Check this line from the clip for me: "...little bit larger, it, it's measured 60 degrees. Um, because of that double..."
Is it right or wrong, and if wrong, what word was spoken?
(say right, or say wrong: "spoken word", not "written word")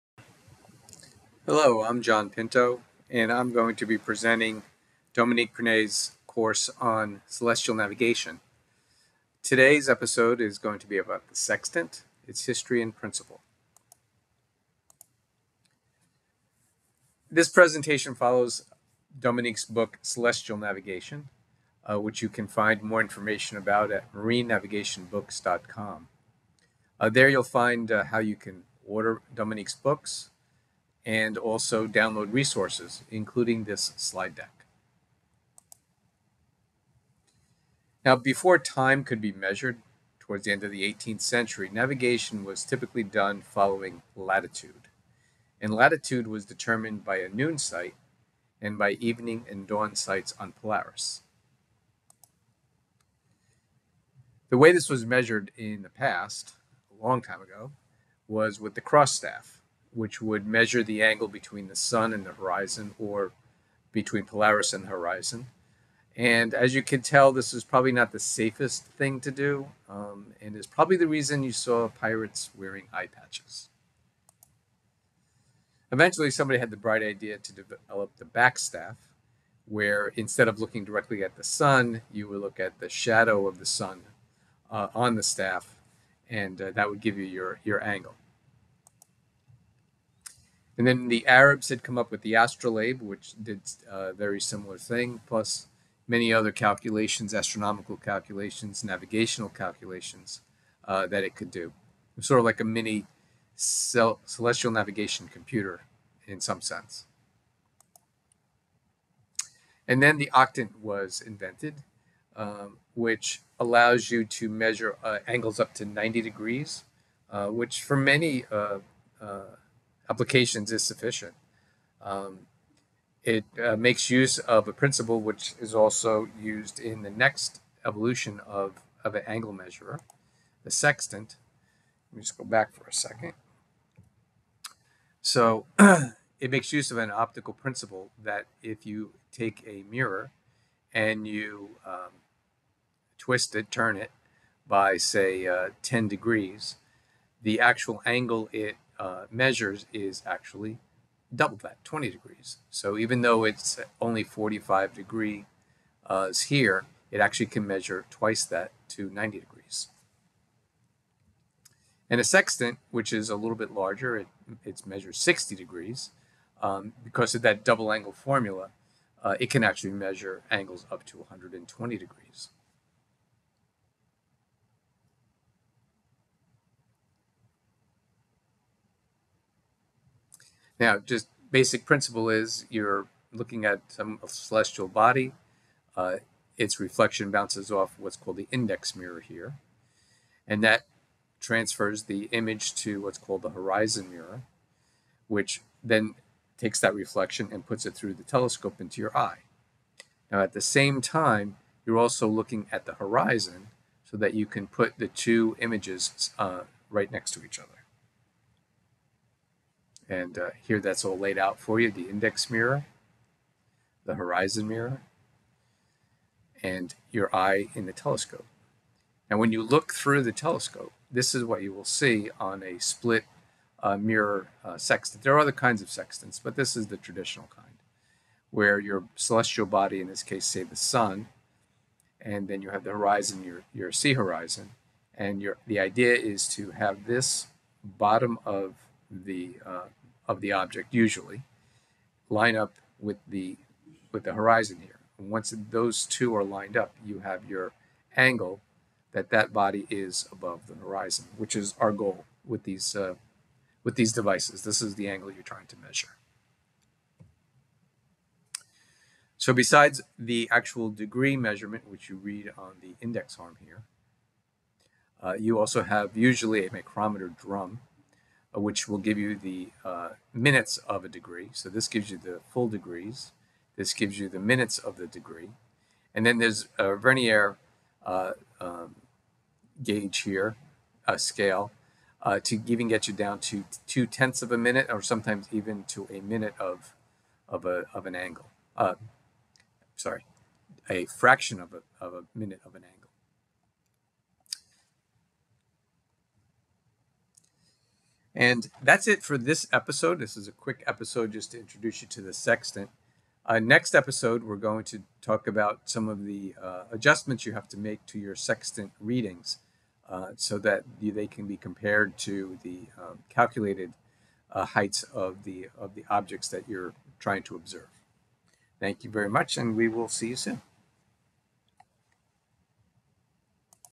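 right.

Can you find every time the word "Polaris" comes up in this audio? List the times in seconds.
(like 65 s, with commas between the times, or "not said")
50 s, 64 s.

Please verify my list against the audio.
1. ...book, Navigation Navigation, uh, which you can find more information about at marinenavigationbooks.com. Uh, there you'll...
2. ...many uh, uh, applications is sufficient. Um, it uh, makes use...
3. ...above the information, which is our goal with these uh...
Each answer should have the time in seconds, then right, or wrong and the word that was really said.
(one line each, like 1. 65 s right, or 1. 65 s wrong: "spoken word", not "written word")
1. 19 s wrong: "Celestial", not "Navigation"
2. 117 s right
3. 250 s wrong: "horizon", not "information".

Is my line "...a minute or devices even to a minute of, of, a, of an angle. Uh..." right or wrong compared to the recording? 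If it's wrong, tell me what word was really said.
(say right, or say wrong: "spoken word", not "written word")
wrong: "sometimes", not "devices".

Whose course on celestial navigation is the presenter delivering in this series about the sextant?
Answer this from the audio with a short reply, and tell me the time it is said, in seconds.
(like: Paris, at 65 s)
Dominique Prinet, at 5 s.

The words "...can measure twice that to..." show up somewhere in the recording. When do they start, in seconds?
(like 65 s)
157 s.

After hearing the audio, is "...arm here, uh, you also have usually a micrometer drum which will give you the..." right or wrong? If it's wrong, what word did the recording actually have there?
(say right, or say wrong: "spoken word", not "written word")
right.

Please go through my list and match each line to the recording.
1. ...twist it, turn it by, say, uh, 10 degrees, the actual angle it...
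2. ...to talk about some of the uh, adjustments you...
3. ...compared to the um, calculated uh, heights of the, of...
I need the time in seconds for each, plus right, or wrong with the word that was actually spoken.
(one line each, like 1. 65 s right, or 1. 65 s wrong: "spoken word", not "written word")
1. 143 s right
2. 304 s right
3. 311 s right.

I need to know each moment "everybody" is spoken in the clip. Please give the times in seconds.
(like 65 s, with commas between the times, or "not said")
not said.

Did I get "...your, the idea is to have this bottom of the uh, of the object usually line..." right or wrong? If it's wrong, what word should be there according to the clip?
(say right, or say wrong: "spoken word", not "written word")
right.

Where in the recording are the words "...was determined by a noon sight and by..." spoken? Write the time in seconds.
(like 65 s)
46 s.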